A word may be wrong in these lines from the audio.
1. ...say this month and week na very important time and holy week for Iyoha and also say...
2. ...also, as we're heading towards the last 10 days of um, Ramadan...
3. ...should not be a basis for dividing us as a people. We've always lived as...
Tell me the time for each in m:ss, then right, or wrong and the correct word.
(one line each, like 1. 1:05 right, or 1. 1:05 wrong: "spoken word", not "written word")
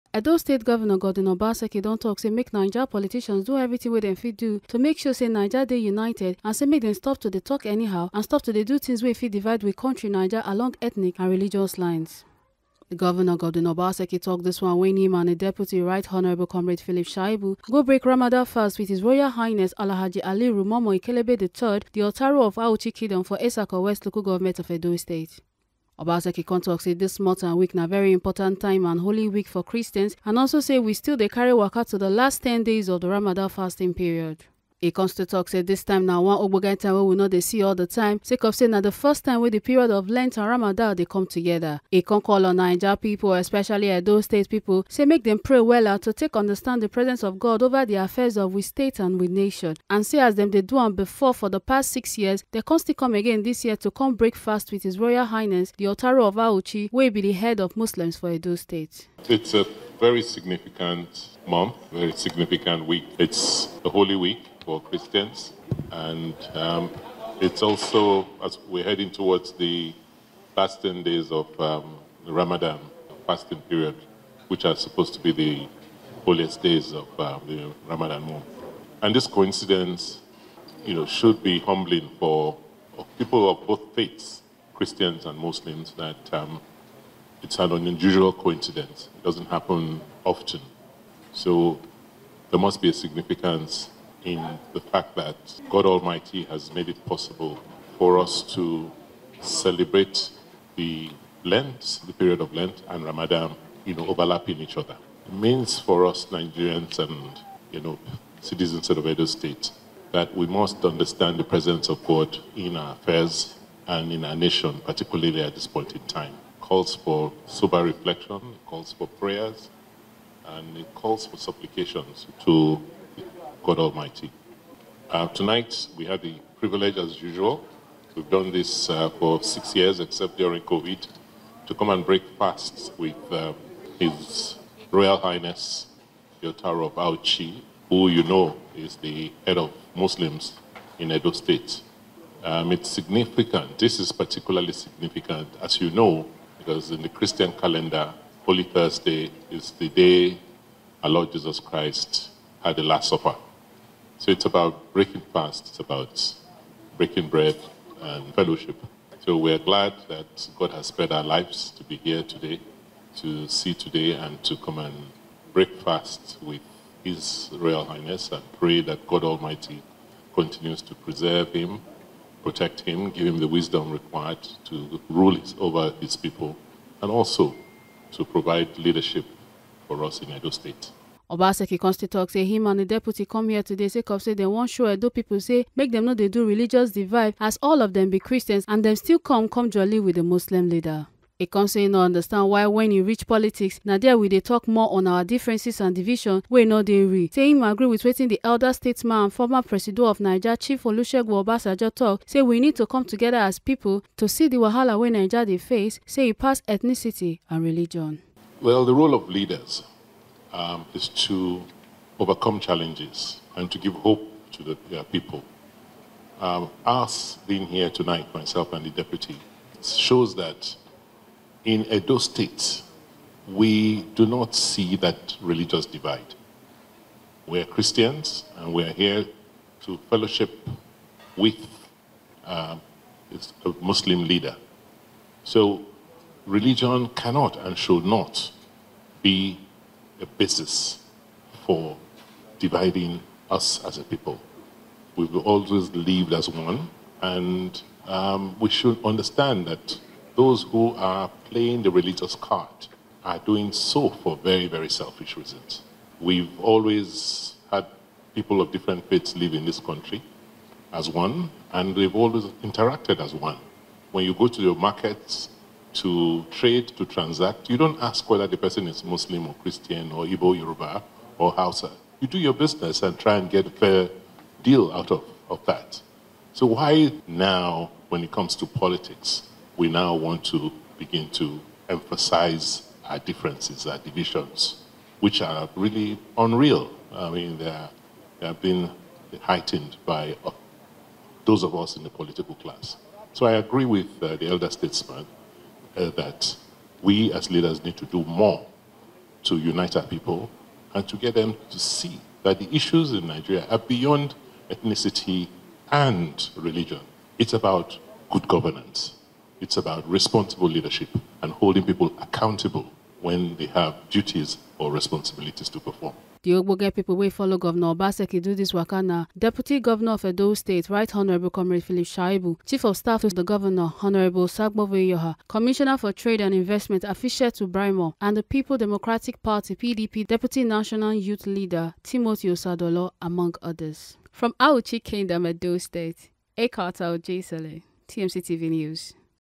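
1. 0:26 wrong: "Christians", not "Iyoha"
2. 1:07 right
3. 3:57 right.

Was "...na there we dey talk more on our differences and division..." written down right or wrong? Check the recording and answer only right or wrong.
right.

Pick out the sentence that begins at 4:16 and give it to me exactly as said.
We've always had people of different faiths live in this country as one, and we have always interacted as one.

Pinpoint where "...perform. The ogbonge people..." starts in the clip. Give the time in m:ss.
5:15.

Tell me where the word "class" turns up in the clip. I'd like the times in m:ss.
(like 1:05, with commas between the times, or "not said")
4:52.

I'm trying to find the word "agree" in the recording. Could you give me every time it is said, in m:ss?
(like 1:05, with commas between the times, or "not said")
3:17, 4:53.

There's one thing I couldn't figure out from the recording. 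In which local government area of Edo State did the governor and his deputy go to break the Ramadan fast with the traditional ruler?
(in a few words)
Esako West.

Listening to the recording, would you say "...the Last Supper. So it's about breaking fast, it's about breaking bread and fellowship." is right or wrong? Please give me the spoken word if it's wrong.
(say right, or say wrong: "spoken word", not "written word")
right.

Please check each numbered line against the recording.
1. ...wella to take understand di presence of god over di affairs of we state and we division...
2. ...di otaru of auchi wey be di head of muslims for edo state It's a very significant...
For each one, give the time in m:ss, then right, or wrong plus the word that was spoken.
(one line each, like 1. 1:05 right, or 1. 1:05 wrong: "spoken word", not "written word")
1. 0:45 wrong: "nation", not "division"
2. 0:55 right.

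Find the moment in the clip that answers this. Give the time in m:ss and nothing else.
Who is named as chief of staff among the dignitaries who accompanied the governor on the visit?
5:24.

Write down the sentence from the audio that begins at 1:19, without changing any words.
And this coincidence, you know, should be humbling for people of both faiths, Christians and Muslims, that um, it's an unusual coincidence.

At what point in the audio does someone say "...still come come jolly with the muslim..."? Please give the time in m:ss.
3:08.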